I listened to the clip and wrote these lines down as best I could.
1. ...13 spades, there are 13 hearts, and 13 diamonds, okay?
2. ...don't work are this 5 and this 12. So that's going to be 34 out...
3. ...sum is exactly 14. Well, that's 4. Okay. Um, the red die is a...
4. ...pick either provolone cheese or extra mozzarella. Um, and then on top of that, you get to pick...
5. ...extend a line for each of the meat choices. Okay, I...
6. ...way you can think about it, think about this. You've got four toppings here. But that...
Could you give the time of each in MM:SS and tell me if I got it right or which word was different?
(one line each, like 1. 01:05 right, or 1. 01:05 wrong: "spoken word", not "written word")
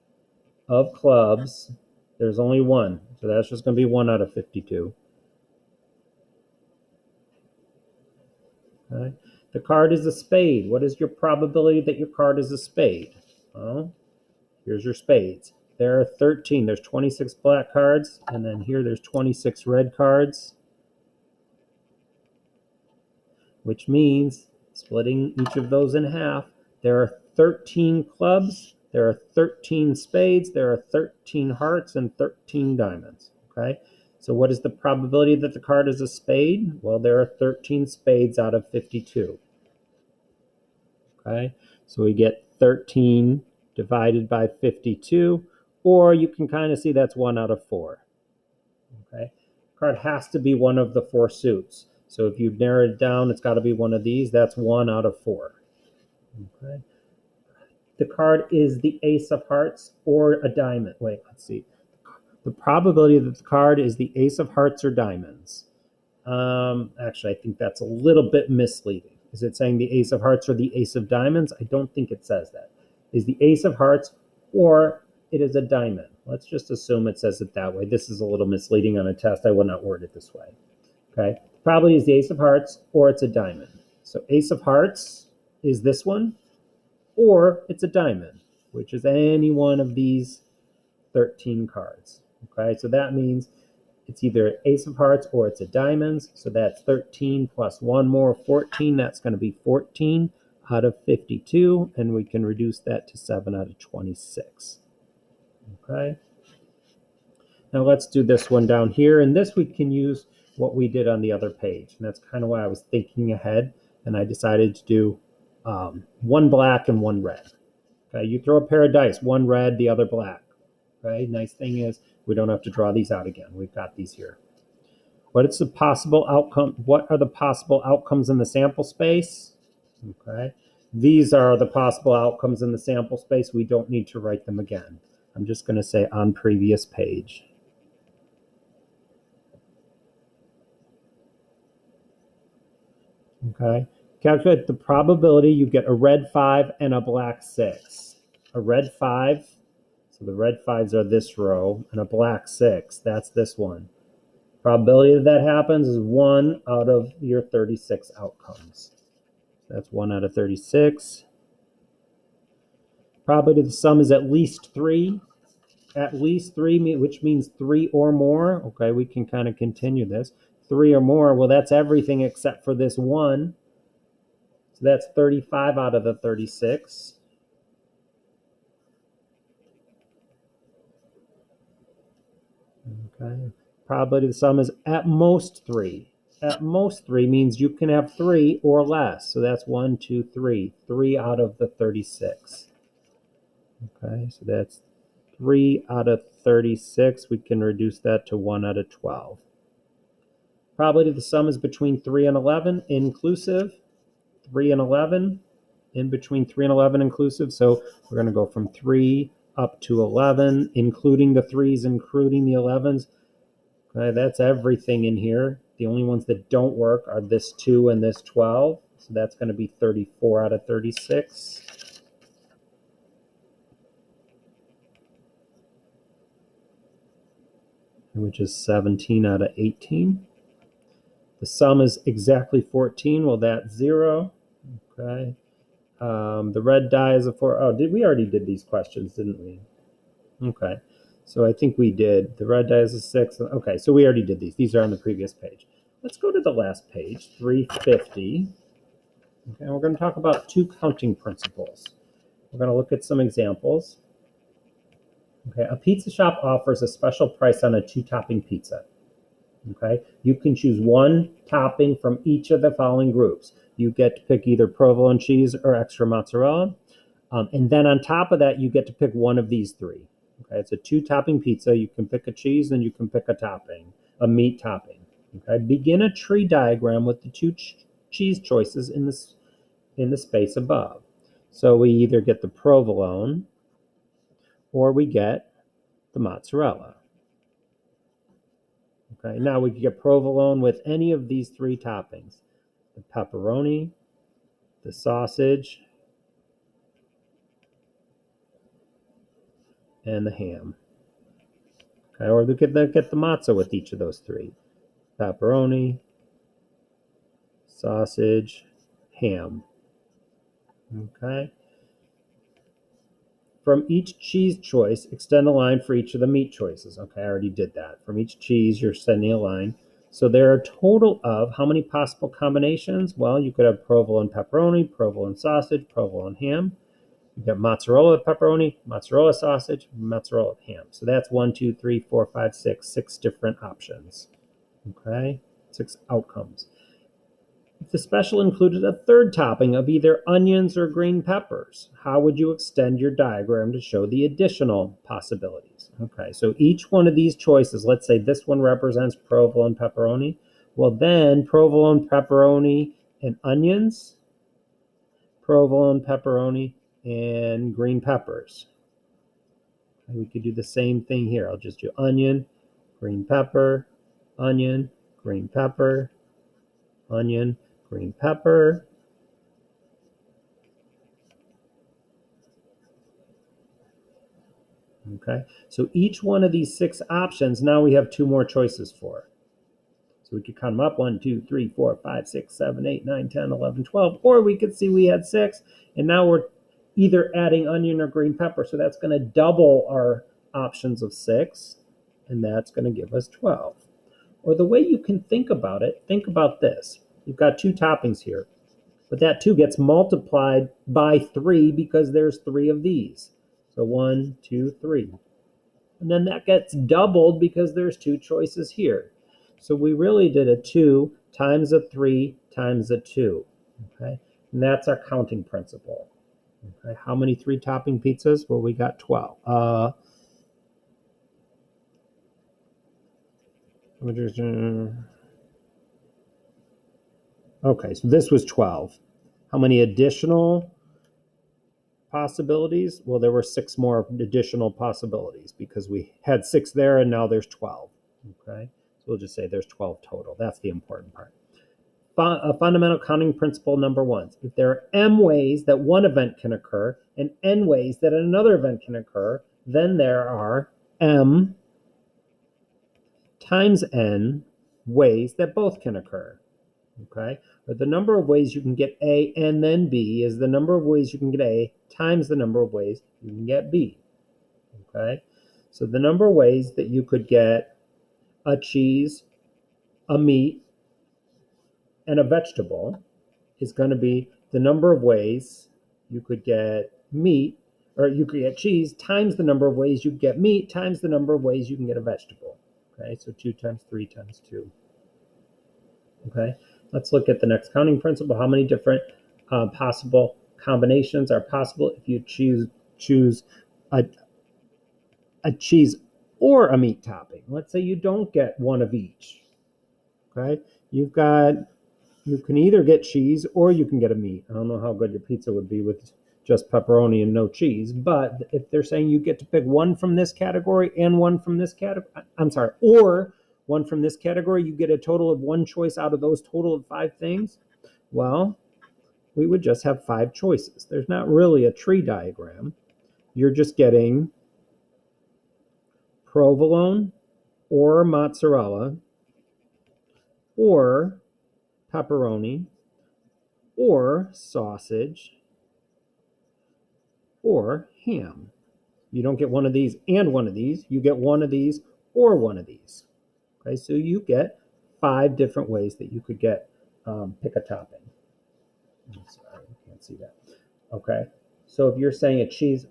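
1. 00:29 right
2. 03:36 wrong: "2", not "5"
3. 03:51 wrong: "0", not "4"
4. 04:24 right
5. 05:15 right
6. 06:34 wrong: "two", not "four".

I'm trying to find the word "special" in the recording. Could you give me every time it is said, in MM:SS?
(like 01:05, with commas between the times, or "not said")
04:16, 05:37.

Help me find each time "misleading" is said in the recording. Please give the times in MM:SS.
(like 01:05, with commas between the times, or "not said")
01:08, 01:18.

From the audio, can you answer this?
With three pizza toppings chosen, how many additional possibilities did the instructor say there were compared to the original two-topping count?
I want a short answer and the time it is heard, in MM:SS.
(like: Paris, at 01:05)
6, at 07:13.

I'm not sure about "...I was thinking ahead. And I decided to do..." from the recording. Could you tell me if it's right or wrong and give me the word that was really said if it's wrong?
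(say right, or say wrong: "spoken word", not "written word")
right.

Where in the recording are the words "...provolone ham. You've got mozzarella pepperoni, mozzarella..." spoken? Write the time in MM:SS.
05:25.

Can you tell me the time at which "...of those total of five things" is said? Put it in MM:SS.
08:36.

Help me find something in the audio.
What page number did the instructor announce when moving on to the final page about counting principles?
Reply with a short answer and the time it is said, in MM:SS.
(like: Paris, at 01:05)
350, at 04:07.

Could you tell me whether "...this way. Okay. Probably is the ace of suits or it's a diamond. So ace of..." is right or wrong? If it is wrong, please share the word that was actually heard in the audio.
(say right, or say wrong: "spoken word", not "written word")
wrong: "hearts", not "suits".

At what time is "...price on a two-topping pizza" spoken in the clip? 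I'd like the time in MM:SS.
04:17.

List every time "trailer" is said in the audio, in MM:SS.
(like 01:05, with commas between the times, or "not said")
not said.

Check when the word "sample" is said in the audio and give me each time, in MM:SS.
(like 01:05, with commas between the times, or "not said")
02:08, 02:12.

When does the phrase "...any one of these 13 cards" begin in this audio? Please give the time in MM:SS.
01:29.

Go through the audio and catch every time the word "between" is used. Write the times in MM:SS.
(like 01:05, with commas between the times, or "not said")
03:21, 03:26.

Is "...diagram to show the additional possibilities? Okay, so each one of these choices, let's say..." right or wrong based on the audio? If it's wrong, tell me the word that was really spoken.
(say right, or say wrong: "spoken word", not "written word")
right.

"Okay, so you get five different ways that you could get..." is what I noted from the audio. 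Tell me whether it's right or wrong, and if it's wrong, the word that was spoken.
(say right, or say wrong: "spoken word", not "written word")
right.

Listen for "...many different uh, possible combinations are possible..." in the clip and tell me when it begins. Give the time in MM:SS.
08:08.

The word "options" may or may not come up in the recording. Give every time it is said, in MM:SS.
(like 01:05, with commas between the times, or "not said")
05:33, 06:17, 06:30.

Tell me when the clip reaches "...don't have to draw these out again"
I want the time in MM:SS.
02:02.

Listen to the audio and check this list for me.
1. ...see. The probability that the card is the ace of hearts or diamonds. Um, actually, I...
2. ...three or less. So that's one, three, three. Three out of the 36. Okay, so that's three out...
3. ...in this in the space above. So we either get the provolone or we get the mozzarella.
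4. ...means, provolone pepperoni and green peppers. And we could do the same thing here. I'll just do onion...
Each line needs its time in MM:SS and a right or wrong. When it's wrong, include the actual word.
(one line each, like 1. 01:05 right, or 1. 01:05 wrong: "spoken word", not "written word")
1. 01:01 right
2. 03:08 wrong: "two", not "three"
3. 04:38 right
4. 05:53 wrong: "onions", not "means".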